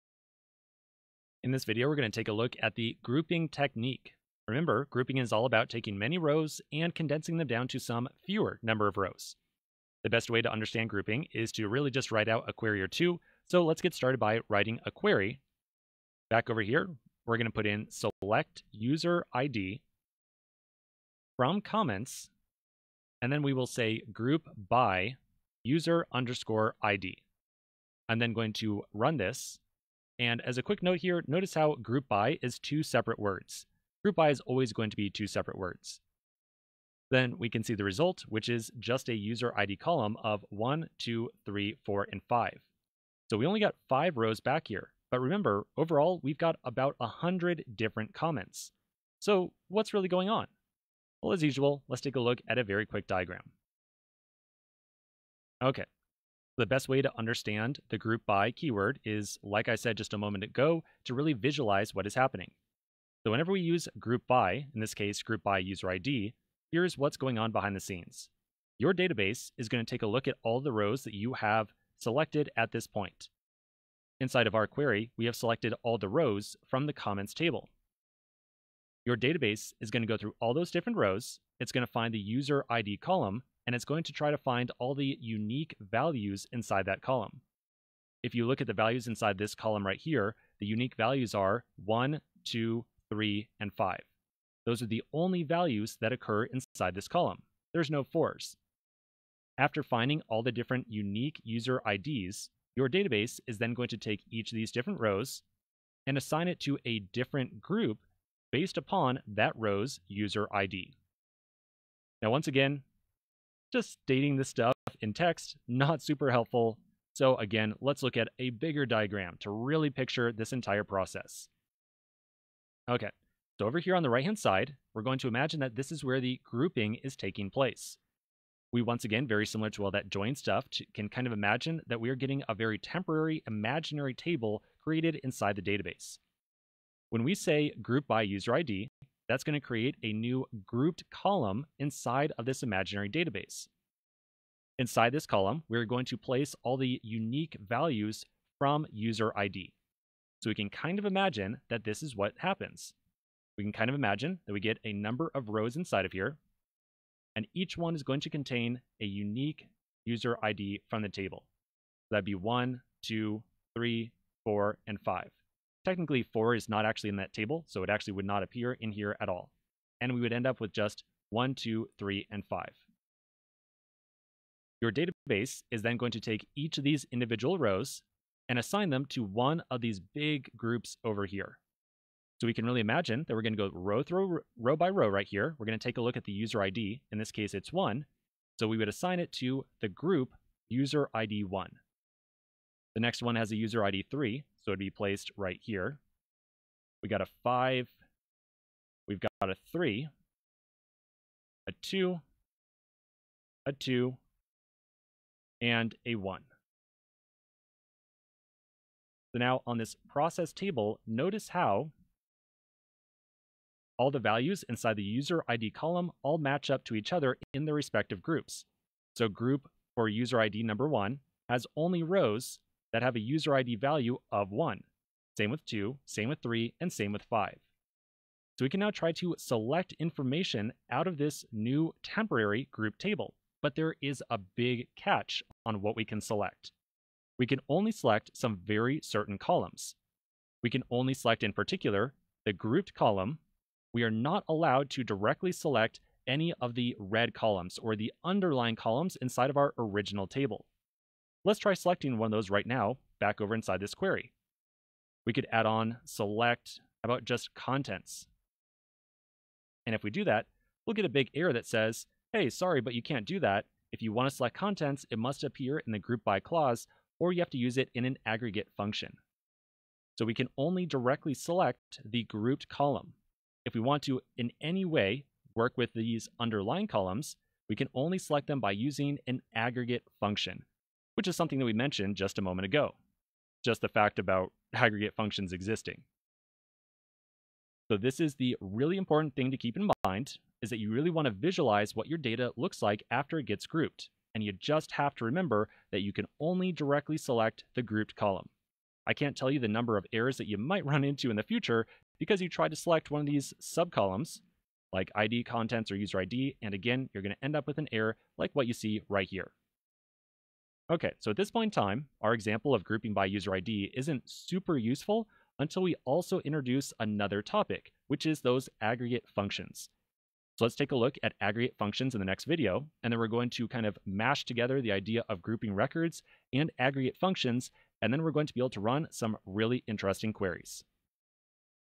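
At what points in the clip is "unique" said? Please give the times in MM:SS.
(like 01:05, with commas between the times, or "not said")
01:25, 01:30, 01:40, 02:27, 02:39.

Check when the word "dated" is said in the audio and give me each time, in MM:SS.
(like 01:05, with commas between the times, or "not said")
not said.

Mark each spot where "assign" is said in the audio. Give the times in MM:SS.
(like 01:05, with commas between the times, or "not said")
01:46, 02:58, 03:08.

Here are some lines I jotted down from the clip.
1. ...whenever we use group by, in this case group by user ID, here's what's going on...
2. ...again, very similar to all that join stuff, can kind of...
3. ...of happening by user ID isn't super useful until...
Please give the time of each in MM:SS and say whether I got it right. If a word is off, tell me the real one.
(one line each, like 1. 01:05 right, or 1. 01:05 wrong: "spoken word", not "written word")
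1. 01:03 right
2. 02:09 right
3. 05:12 wrong: "grouping", not "happening".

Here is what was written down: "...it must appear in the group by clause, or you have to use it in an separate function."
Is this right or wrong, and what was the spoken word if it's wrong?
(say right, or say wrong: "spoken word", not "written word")
wrong: "aggregate", not "separate".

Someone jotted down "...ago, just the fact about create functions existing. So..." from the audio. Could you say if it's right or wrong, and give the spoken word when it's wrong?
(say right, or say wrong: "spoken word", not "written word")
wrong: "aggregate", not "create".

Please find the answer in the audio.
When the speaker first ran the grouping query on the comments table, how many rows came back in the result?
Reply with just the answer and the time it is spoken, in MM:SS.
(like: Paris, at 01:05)
5, at 00:43.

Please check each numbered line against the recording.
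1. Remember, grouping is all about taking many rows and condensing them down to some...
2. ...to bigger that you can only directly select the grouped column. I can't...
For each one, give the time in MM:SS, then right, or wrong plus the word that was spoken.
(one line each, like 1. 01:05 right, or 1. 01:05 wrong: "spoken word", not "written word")
1. 00:04 right
2. 04:55 wrong: "remember", not "bigger".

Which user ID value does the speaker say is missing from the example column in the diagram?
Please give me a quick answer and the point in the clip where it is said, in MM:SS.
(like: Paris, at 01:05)
4, at 01:37.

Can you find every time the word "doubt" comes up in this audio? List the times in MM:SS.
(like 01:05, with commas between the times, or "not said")
not said.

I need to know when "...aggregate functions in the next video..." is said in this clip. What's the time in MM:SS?
05:21.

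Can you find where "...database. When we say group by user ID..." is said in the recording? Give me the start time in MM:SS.
02:15.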